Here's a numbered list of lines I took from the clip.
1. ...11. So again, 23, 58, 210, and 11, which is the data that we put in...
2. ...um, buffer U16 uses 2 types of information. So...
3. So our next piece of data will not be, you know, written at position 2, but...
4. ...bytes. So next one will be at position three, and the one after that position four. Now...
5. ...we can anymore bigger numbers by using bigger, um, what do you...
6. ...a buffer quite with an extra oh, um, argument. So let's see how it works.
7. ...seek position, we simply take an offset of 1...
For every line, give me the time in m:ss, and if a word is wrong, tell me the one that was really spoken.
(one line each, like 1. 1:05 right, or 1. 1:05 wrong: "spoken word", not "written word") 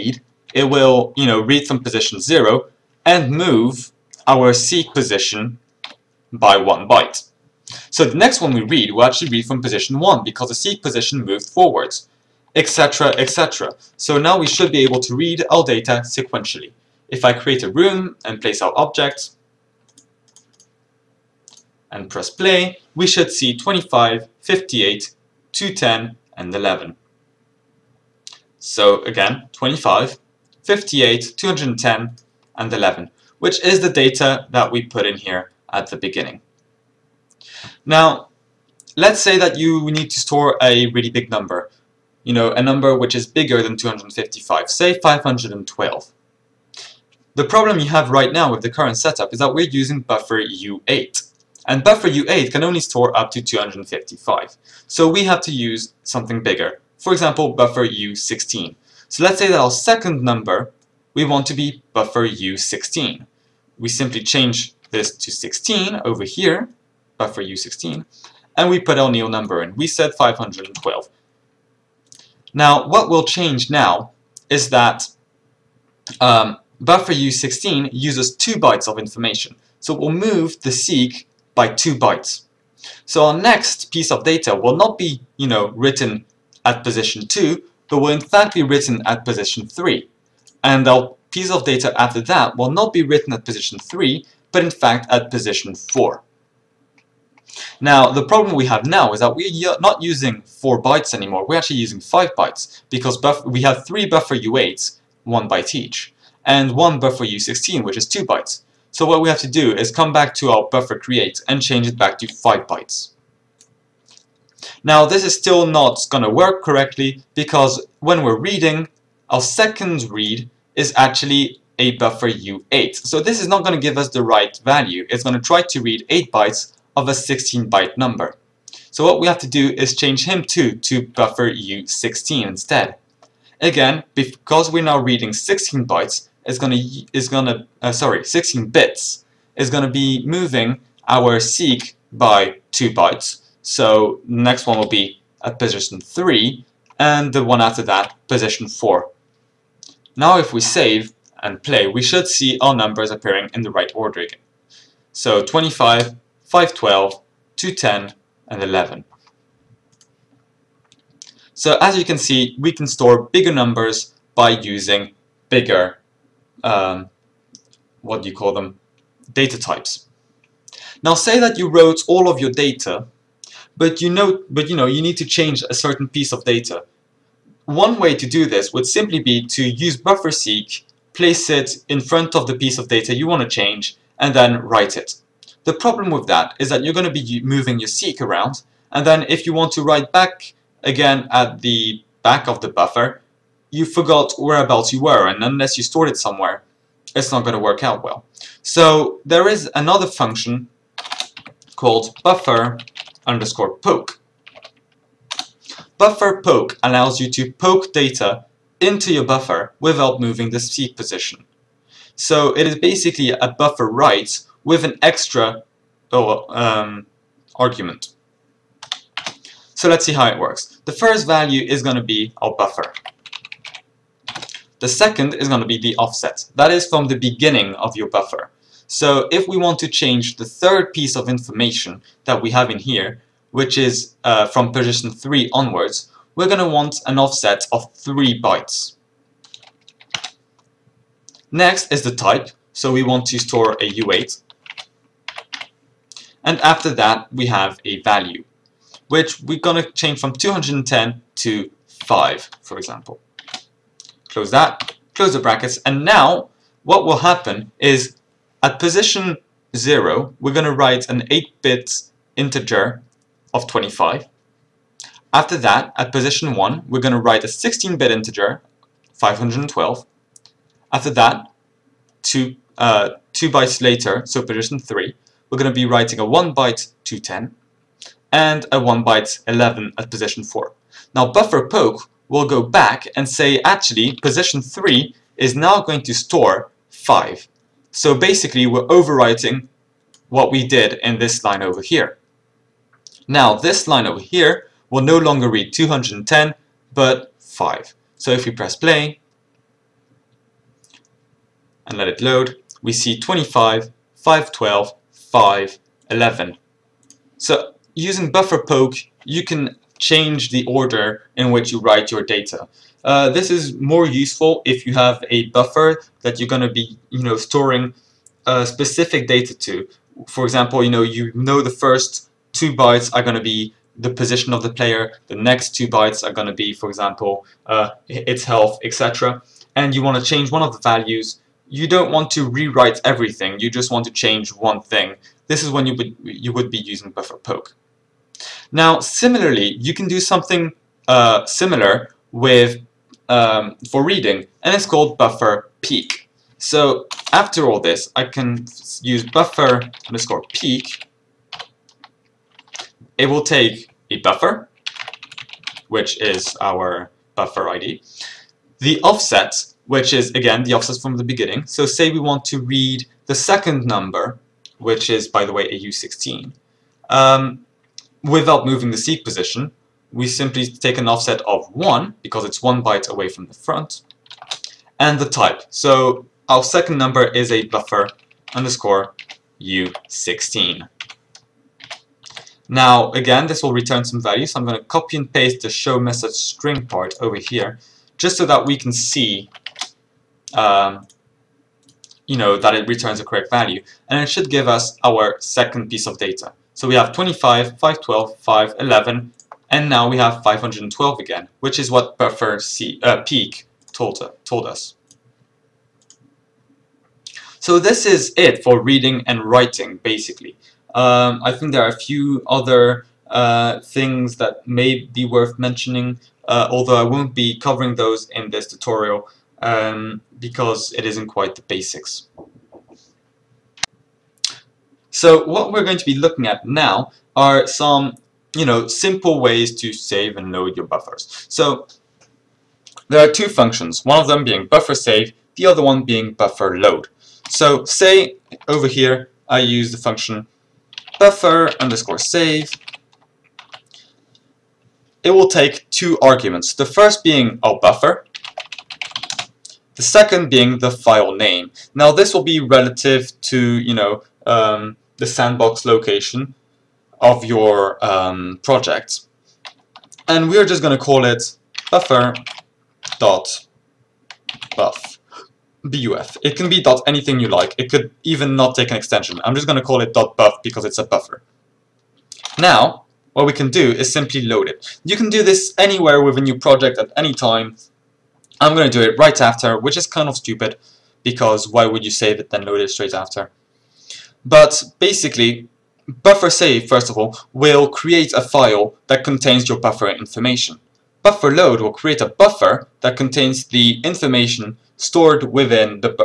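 1. 0:26 wrong: "25", not "23"
2. 1:16 wrong: "bytes", not "types"
3. 1:23 right
4. 2:22 right
5. 2:42 wrong: "store", not "anymore"
6. 3:33 wrong: "write", not "quite"
7. 6:08 right.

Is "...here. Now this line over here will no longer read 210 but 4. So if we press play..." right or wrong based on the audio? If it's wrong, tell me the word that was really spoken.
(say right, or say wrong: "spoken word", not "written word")
wrong: "5", not "4".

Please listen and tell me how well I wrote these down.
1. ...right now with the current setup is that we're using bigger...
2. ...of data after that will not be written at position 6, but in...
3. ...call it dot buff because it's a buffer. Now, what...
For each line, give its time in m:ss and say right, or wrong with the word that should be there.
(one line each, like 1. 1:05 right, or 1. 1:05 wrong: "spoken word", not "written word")
1. 0:48 wrong: "buffer", not "bigger"
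2. 1:31 wrong: "3", not "6"
3. 7:49 right.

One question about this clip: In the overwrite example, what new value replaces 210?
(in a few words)
5.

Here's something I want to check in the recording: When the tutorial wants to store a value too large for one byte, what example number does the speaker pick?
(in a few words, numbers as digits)
512.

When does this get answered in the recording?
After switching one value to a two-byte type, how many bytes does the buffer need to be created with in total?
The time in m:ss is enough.
1:51.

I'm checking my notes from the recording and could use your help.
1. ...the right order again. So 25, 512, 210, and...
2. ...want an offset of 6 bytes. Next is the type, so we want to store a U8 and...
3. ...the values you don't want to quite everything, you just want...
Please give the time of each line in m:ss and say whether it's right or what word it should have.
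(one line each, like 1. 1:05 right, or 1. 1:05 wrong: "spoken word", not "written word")
1. 2:33 right
2. 3:56 wrong: "3", not "6"
3. 5:30 wrong: "rewrite", not "quite".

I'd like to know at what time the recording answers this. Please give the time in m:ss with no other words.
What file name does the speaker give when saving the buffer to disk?
7:41.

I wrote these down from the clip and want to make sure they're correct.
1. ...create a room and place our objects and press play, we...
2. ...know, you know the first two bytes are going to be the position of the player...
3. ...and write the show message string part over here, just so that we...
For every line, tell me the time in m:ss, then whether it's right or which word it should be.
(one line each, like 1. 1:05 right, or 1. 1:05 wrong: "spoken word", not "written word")
1. 0:17 right
2. 5:20 right
3. 6:25 wrong: "paste", not "write".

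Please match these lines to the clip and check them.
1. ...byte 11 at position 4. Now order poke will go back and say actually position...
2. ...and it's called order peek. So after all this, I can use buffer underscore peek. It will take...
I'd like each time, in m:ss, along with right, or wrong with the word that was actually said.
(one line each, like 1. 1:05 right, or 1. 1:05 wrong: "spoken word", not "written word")
1. 4:39 wrong: "buffer", not "order"
2. 5:44 wrong: "buffer", not "order".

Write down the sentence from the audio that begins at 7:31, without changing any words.
Now this will be relative to, you know, um, the sandbox location of your um, project.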